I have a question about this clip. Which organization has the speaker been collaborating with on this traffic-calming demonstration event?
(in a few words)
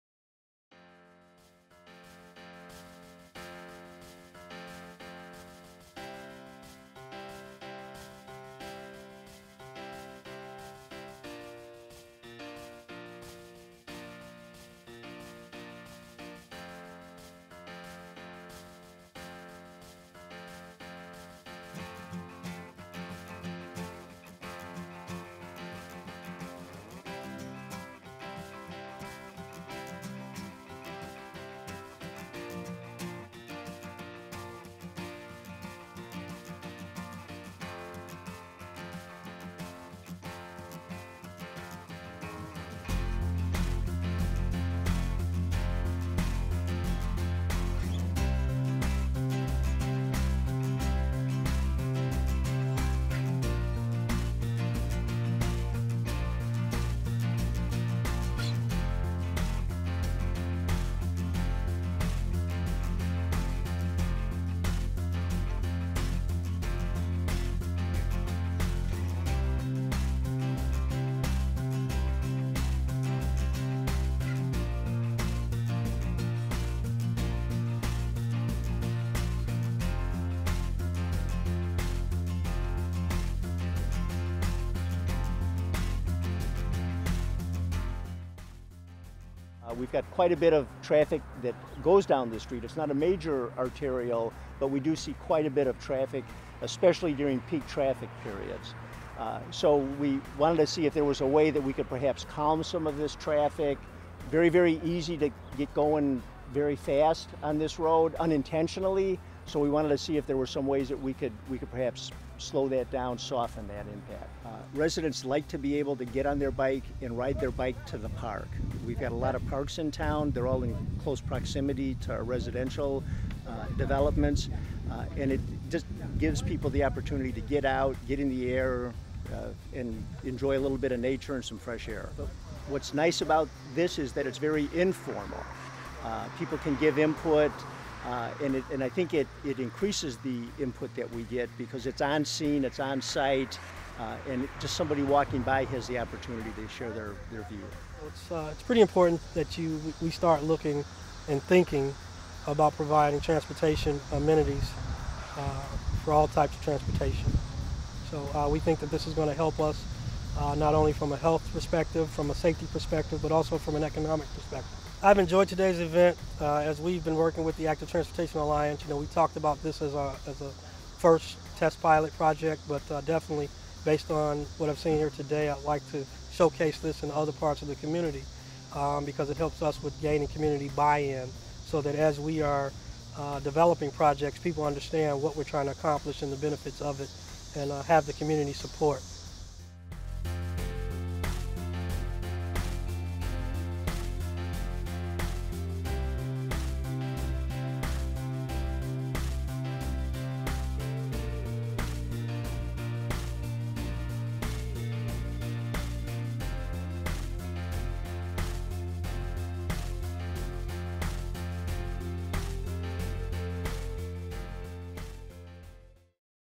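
Active Transportation Alliance.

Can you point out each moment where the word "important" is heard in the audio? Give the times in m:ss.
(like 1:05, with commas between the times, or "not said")
2:28.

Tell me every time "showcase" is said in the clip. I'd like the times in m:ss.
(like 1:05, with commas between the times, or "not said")
2:56.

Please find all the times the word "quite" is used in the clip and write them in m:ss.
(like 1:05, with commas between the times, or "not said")
1:30, 1:35.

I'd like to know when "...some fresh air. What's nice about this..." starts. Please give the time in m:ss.
2:11.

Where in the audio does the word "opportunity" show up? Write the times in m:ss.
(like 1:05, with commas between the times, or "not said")
2:06, 2:25.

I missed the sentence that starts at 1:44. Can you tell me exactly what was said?
Very, very easy to get going very fast on this road unintentionally.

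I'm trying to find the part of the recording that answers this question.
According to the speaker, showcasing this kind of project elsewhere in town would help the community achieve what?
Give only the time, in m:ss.
3:00.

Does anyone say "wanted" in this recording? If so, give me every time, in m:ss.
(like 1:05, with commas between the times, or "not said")
1:40, 1:49.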